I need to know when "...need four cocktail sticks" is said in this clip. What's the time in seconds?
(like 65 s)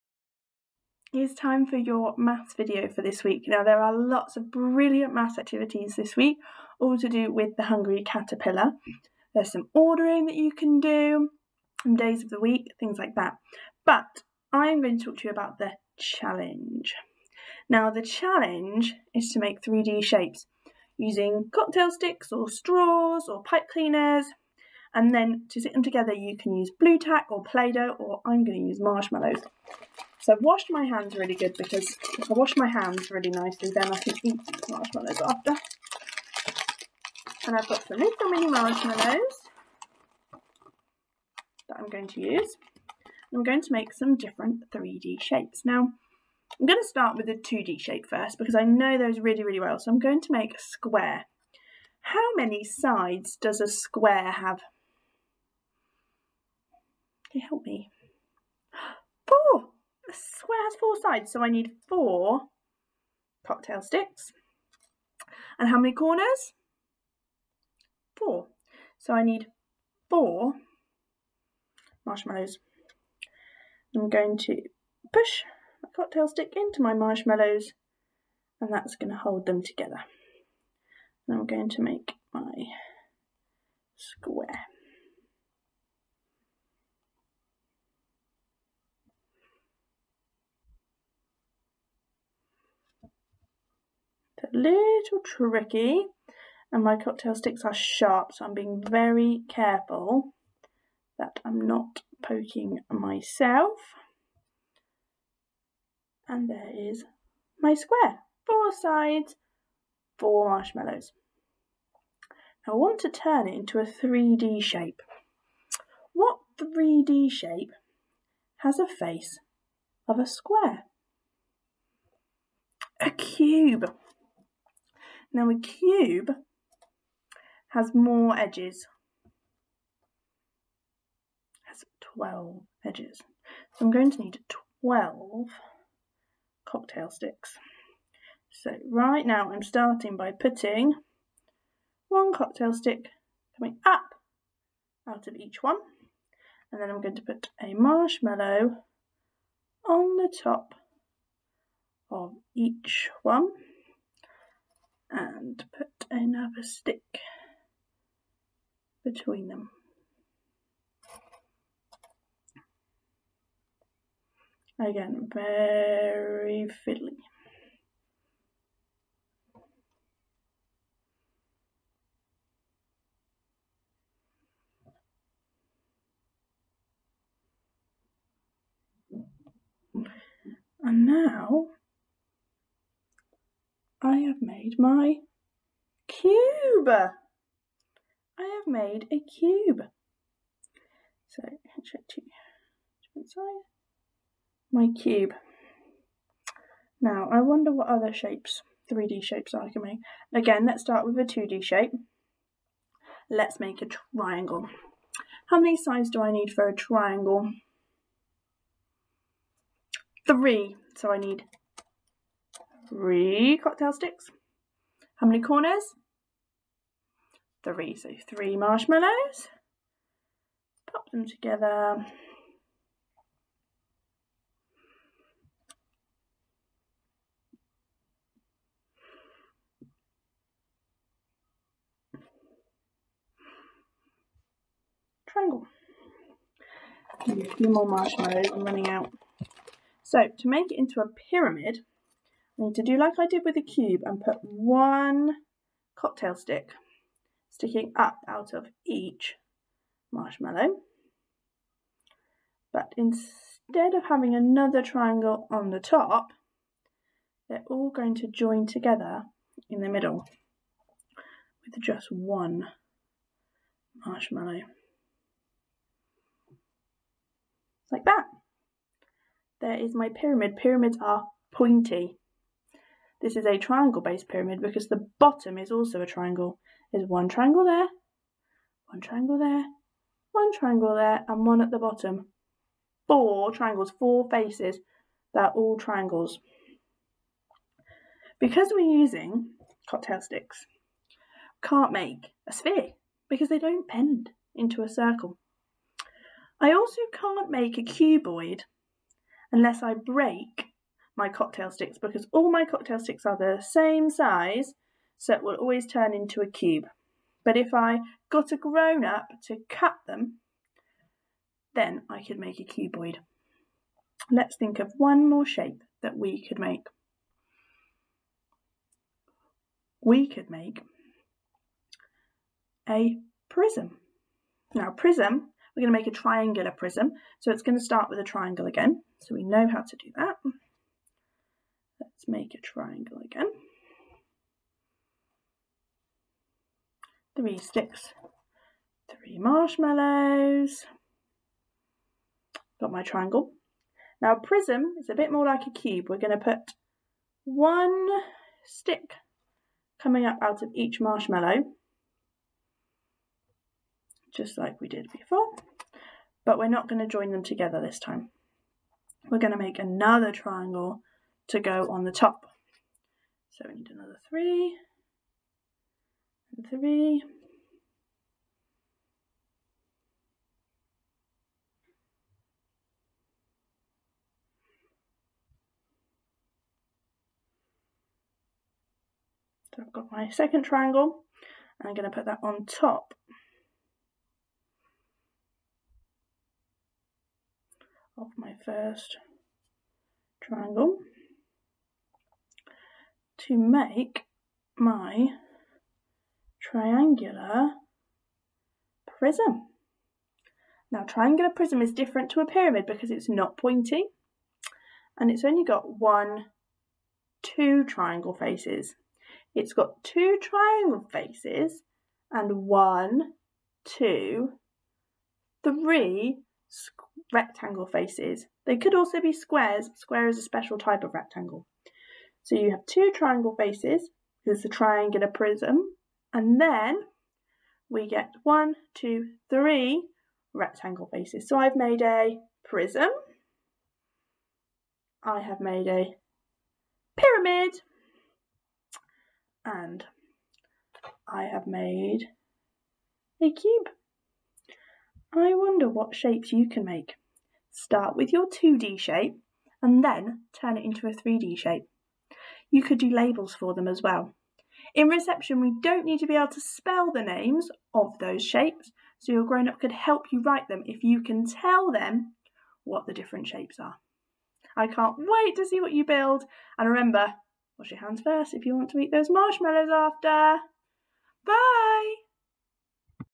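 61 s.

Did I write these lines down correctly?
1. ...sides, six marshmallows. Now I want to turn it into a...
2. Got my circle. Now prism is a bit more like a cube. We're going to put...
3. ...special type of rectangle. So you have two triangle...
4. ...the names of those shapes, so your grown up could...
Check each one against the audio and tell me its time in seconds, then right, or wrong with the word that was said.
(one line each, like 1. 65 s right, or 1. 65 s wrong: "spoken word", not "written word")
1. 108 s wrong: "four", not "six"
2. 342 s wrong: "triangle", not "circle"
3. 420 s right
4. 457 s right.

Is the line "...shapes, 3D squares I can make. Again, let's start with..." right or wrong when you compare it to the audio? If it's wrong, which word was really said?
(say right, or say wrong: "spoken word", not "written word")
wrong: "shapes", not "squares".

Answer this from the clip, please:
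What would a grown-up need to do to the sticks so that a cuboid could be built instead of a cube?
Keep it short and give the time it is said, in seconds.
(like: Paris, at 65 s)
Cut them, at 309 s.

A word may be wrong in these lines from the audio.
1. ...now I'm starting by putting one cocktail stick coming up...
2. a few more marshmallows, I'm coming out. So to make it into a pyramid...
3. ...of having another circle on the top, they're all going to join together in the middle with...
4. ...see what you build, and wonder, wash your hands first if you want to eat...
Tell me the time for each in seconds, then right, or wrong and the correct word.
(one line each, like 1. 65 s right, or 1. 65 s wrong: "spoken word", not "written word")
1. 139 s right
2. 237 s wrong: "running", not "coming"
3. 253 s wrong: "triangle", not "circle"
4. 465 s wrong: "remember", not "wonder".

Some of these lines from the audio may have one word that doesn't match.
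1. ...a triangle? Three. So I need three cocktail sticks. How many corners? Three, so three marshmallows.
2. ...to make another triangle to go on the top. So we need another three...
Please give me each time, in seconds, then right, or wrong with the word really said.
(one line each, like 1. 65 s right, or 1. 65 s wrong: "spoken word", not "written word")
1. 206 s right
2. 359 s right.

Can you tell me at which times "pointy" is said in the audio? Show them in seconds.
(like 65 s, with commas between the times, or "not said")
271 s, 403 s.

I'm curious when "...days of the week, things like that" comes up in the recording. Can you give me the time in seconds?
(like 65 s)
11 s.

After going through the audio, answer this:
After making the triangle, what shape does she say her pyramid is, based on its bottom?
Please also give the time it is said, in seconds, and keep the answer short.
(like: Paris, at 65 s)
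Triangle based pyramid, at 273 s.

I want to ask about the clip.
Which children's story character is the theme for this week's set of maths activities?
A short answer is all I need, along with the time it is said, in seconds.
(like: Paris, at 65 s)
The hungry caterpillar, at 7 s.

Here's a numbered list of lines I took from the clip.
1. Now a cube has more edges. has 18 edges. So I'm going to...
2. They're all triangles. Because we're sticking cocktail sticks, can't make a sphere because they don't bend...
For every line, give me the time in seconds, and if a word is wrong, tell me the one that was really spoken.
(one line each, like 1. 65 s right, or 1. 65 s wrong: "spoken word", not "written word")
1. 125 s wrong: "12", not "18"
2. 285 s wrong: "using", not "sticking".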